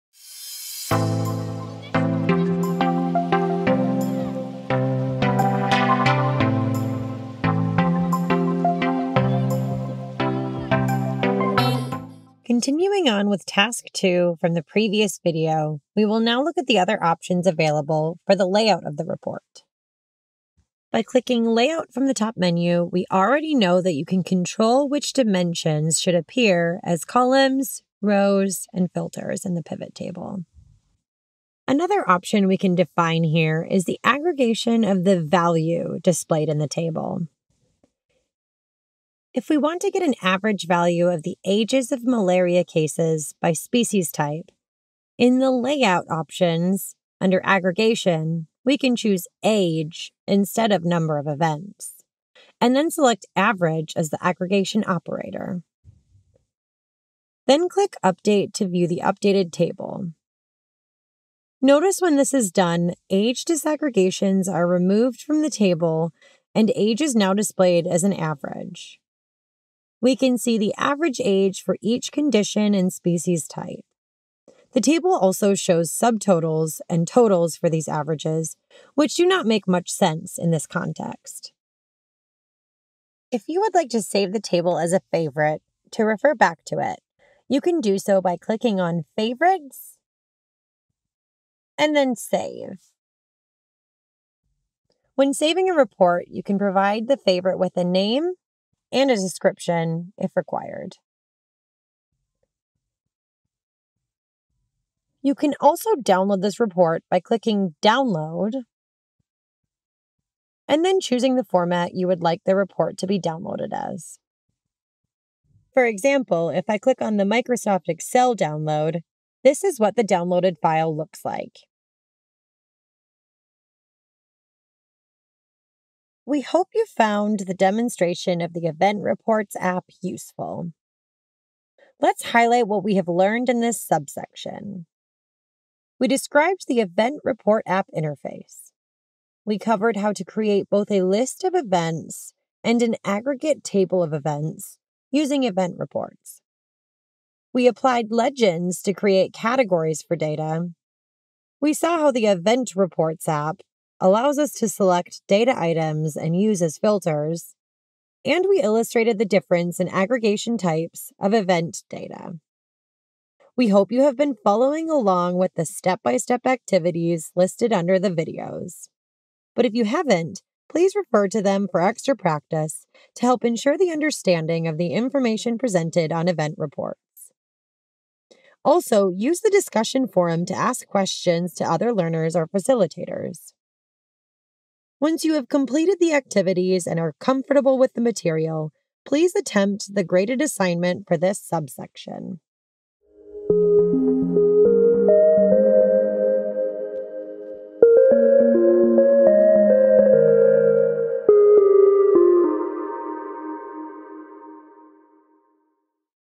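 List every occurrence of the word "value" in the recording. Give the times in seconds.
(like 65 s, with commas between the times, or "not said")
35 s, 40 s.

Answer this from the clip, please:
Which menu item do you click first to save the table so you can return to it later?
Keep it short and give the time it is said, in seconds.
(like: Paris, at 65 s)
Favorites, at 89 s.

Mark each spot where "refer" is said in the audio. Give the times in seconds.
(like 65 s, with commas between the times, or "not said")
86 s, 170 s.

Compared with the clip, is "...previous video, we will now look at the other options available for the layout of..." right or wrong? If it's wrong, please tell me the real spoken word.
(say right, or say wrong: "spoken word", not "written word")
right.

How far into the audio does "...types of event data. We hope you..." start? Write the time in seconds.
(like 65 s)
160 s.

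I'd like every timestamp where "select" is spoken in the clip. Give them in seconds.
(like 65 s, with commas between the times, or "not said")
52 s, 154 s.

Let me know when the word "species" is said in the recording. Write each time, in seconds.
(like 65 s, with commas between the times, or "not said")
43 s, 72 s.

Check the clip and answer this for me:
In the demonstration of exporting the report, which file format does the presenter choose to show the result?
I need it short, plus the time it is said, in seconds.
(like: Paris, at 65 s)
Microsoft Excel, at 117 s.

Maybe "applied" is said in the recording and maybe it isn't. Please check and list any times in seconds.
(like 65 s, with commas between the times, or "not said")
147 s.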